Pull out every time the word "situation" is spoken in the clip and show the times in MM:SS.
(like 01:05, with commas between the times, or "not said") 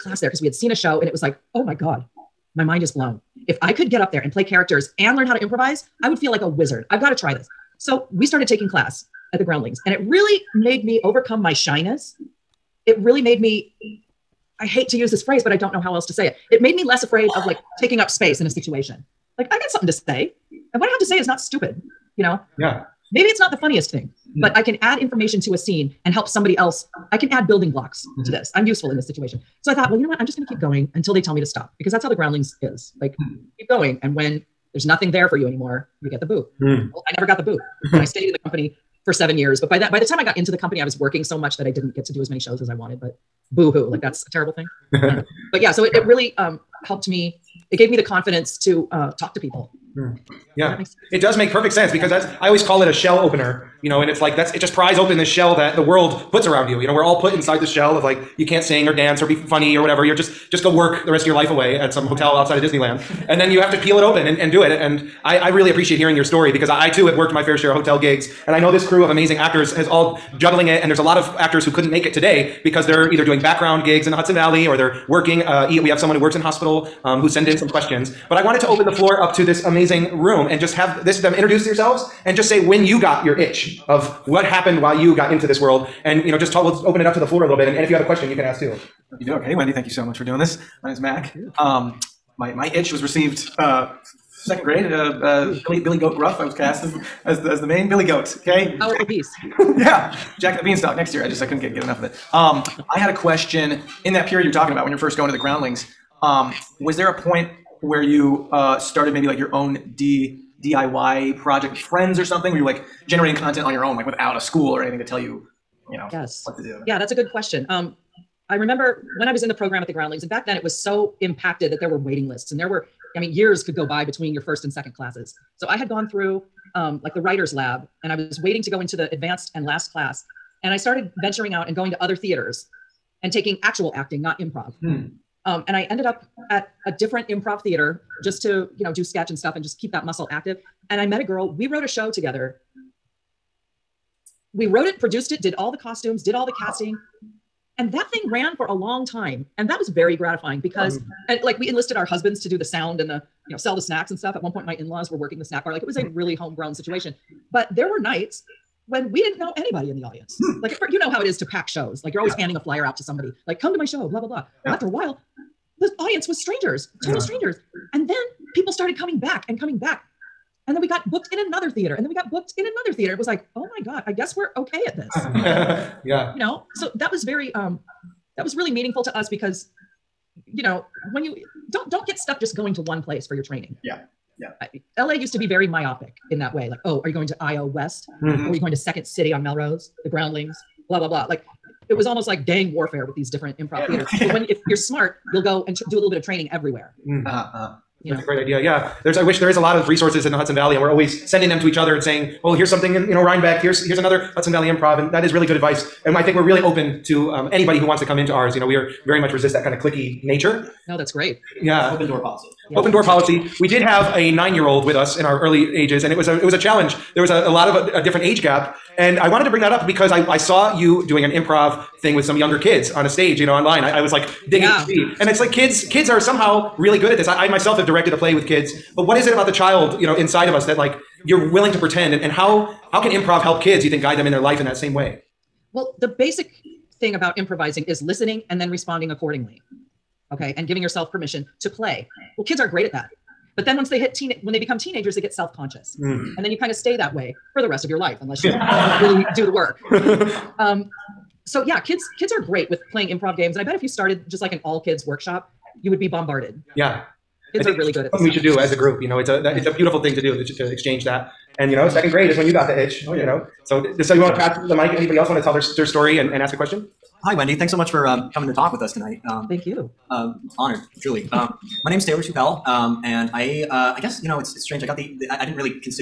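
00:18, 00:29, 02:36.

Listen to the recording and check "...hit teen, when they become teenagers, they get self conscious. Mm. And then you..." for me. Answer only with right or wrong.
right.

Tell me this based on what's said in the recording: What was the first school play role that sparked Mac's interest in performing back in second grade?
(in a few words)
Billy Goat Gruff.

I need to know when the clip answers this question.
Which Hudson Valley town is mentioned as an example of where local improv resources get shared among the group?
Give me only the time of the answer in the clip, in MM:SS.
03:23.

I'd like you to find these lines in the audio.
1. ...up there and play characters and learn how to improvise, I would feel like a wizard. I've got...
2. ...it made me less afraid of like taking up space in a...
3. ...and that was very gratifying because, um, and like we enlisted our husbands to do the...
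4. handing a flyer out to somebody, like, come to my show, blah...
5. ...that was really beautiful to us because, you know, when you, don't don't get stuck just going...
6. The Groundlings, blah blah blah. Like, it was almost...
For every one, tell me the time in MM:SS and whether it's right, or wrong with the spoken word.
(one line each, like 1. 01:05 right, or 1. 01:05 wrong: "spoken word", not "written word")
1. 00:03 right
2. 00:16 right
3. 02:29 right
4. 02:42 right
5. 02:58 wrong: "meaningful", not "beautiful"
6. 03:10 right.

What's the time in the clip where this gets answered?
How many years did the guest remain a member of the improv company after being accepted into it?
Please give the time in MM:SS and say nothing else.
00:39.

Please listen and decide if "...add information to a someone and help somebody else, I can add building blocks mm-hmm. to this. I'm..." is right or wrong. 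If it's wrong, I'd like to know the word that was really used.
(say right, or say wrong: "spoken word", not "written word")
wrong: "scene", not "someone".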